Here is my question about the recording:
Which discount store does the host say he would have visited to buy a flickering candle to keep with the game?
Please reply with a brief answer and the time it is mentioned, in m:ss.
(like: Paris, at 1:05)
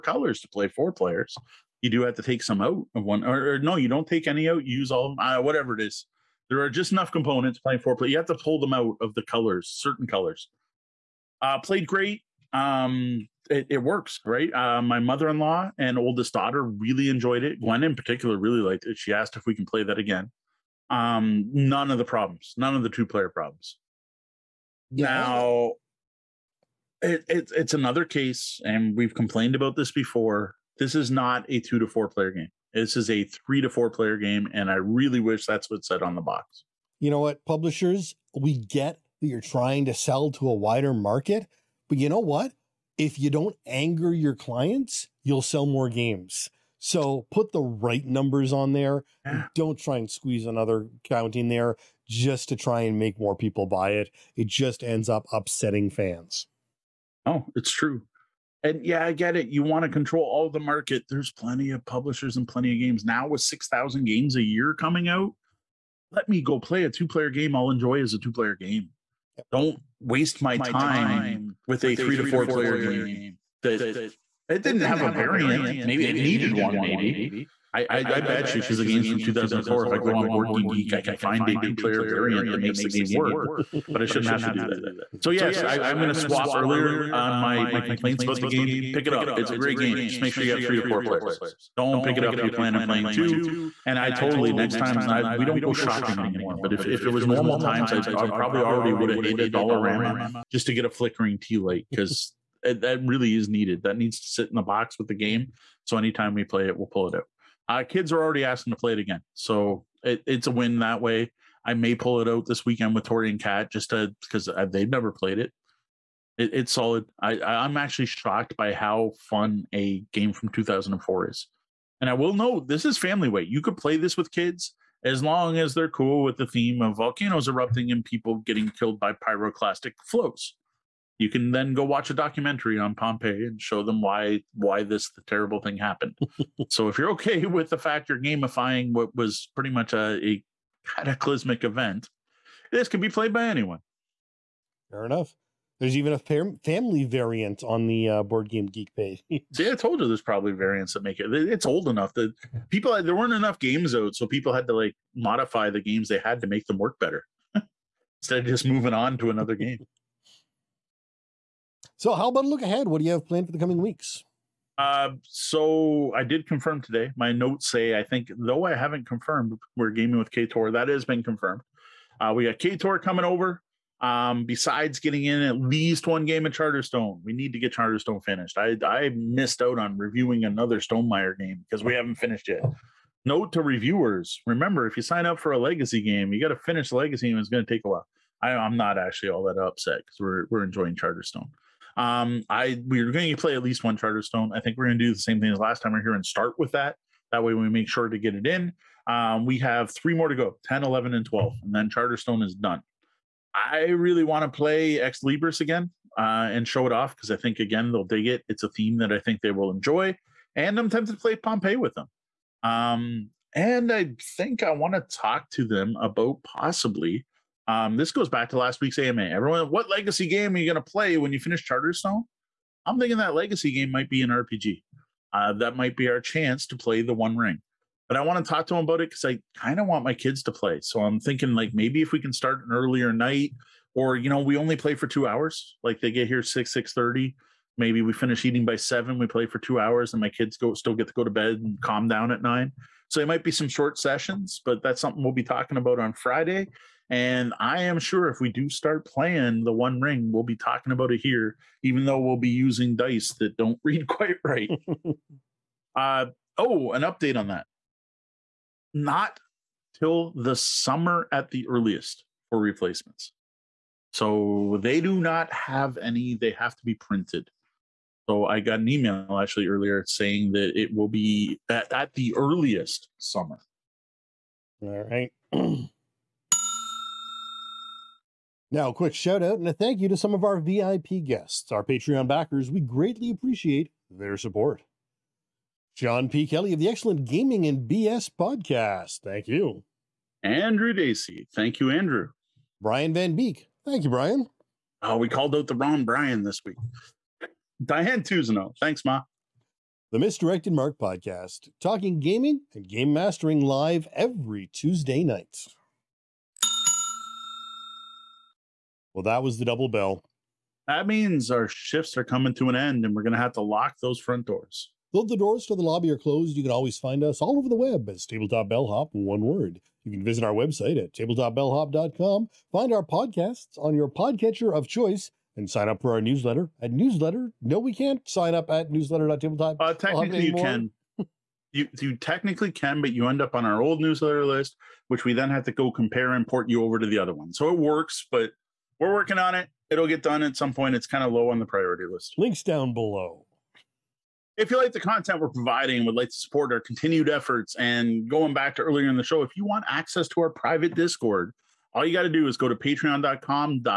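Dollarama, at 1:39.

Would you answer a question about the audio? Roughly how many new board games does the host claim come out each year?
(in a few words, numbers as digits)
6,000.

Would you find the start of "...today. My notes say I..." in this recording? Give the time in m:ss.
2:46.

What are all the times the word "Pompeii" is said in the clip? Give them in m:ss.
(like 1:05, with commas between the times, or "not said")
2:12, 3:31.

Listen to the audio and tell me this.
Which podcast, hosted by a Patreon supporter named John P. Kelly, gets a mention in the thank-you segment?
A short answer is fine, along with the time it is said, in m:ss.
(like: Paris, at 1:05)
Gaming and BS, at 4:47.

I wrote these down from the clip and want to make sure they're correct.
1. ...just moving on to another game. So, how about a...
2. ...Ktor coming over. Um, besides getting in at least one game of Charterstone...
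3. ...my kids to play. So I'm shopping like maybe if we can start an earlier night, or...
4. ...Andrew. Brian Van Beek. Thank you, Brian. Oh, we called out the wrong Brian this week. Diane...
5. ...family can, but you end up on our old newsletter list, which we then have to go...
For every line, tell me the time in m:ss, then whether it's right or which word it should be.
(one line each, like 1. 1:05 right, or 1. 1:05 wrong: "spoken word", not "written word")
1. 2:38 right
2. 2:52 right
3. 3:50 wrong: "thinking", not "shopping"
4. 4:51 right
5. 5:32 wrong: "technically", not "family".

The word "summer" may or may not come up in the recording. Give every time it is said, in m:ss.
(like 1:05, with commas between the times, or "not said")
4:20, 4:33.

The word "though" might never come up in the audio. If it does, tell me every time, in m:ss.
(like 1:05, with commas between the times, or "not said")
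2:48, 4:12, 5:15.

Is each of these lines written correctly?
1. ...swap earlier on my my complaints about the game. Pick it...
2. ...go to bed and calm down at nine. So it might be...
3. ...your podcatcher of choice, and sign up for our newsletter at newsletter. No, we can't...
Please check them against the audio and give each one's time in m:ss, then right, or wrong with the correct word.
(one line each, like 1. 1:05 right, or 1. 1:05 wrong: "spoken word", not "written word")
1. 1:26 right
2. 4:01 right
3. 5:23 right.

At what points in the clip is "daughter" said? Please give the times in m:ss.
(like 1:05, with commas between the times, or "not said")
0:16.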